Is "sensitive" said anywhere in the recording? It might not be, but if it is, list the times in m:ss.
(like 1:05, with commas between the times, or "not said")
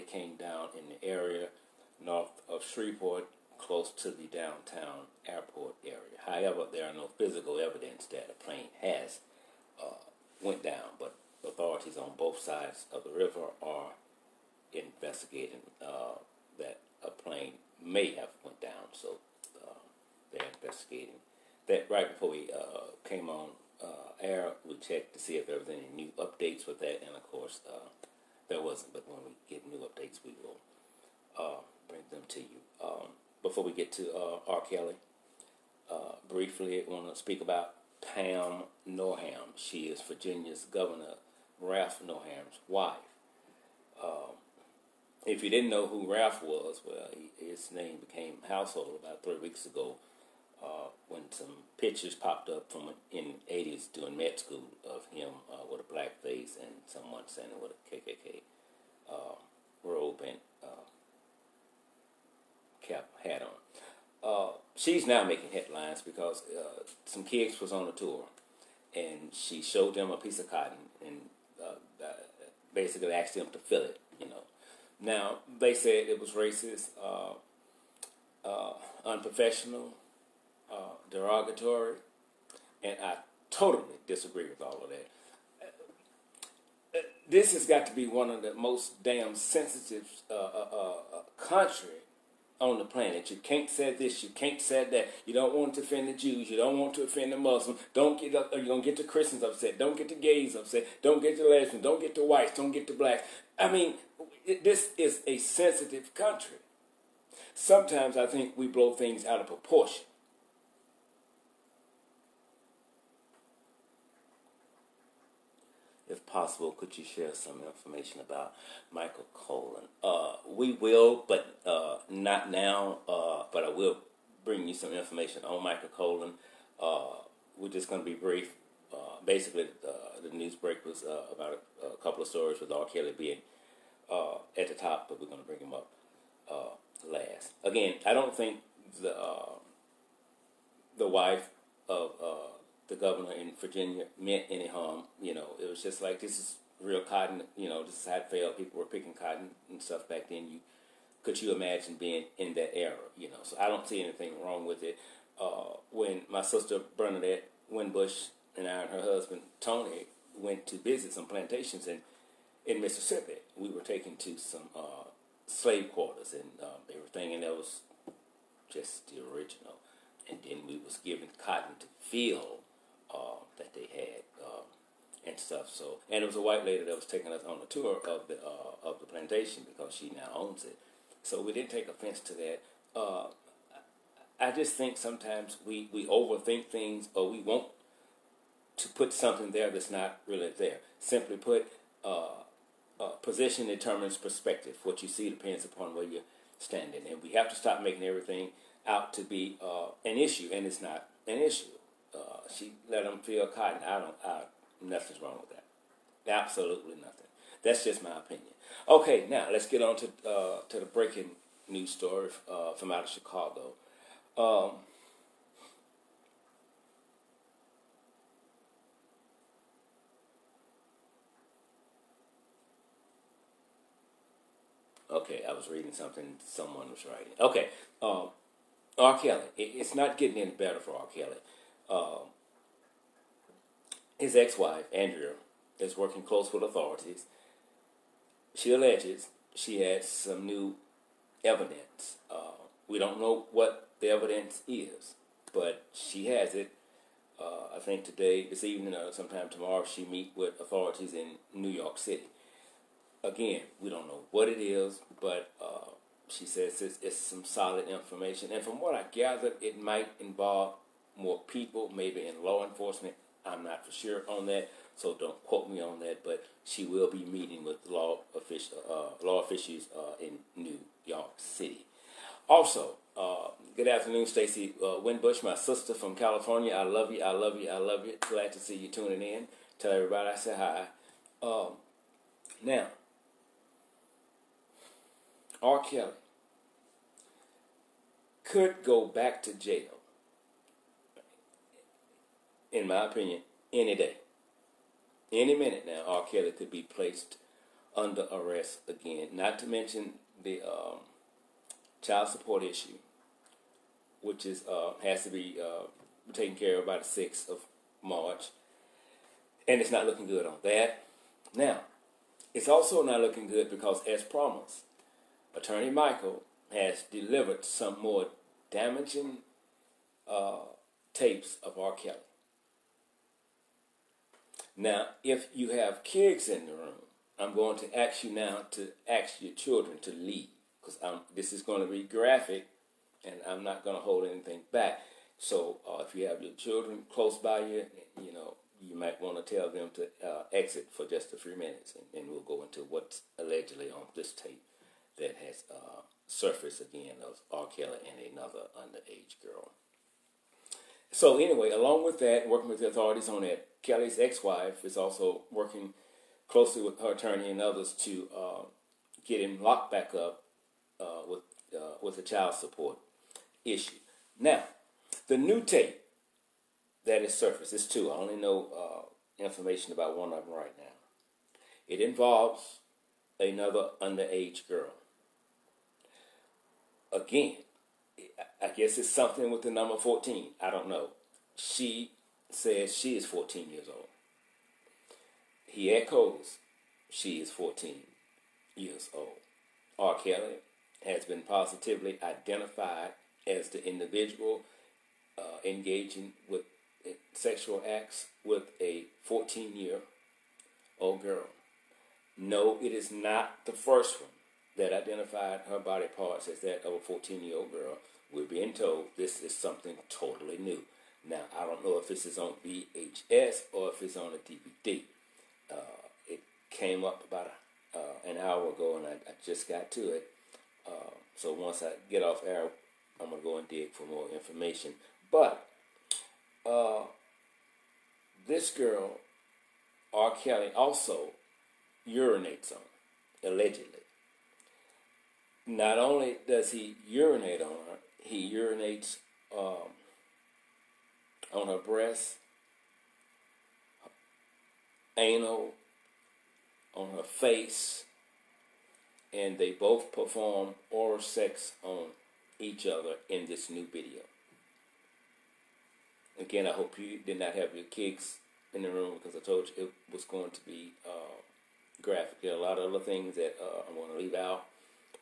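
1:29, 1:45.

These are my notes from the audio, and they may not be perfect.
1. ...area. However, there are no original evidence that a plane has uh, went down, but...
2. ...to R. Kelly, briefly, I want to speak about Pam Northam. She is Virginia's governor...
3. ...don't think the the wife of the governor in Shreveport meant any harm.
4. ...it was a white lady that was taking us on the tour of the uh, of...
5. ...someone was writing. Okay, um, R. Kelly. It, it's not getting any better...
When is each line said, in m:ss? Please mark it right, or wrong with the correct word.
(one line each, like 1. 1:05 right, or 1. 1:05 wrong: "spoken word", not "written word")
1. 0:05 wrong: "physical", not "original"
2. 0:33 right
3. 2:18 wrong: "Virginia", not "Shreveport"
4. 2:56 right
5. 3:46 right.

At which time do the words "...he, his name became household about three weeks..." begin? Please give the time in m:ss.
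0:47.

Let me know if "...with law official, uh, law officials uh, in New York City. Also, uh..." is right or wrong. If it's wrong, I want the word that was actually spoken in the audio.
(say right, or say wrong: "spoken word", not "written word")
right.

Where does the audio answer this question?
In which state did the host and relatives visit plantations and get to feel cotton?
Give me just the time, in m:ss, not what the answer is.
2:42.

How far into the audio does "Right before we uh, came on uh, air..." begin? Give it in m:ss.
0:21.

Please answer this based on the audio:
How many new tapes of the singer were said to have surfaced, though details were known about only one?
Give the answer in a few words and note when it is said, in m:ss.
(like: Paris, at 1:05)
2, at 6:07.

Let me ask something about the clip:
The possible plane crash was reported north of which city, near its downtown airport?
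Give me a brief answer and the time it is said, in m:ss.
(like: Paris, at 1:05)
Shreveport, at 0:02.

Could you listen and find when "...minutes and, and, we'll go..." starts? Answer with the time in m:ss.
5:41.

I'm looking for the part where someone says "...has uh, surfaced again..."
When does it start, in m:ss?
5:45.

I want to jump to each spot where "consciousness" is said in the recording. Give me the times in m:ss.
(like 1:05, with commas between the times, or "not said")
not said.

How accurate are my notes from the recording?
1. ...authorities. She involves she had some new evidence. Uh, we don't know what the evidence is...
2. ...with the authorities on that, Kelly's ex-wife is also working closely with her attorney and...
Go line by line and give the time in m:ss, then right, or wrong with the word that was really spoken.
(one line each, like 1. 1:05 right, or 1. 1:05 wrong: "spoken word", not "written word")
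1. 3:56 wrong: "alleges", not "involves"
2. 5:52 right.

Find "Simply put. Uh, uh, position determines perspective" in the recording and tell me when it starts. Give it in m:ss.
3:10.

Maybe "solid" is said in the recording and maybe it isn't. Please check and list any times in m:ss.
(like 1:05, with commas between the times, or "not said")
4:17.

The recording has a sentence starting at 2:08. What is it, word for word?
Uh, basically, uh, the news break was about a, a, couple of stories with R.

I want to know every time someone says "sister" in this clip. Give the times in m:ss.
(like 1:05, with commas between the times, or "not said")
2:36, 4:35.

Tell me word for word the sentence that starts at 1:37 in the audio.
Don't get up, you don't get the Christians upset.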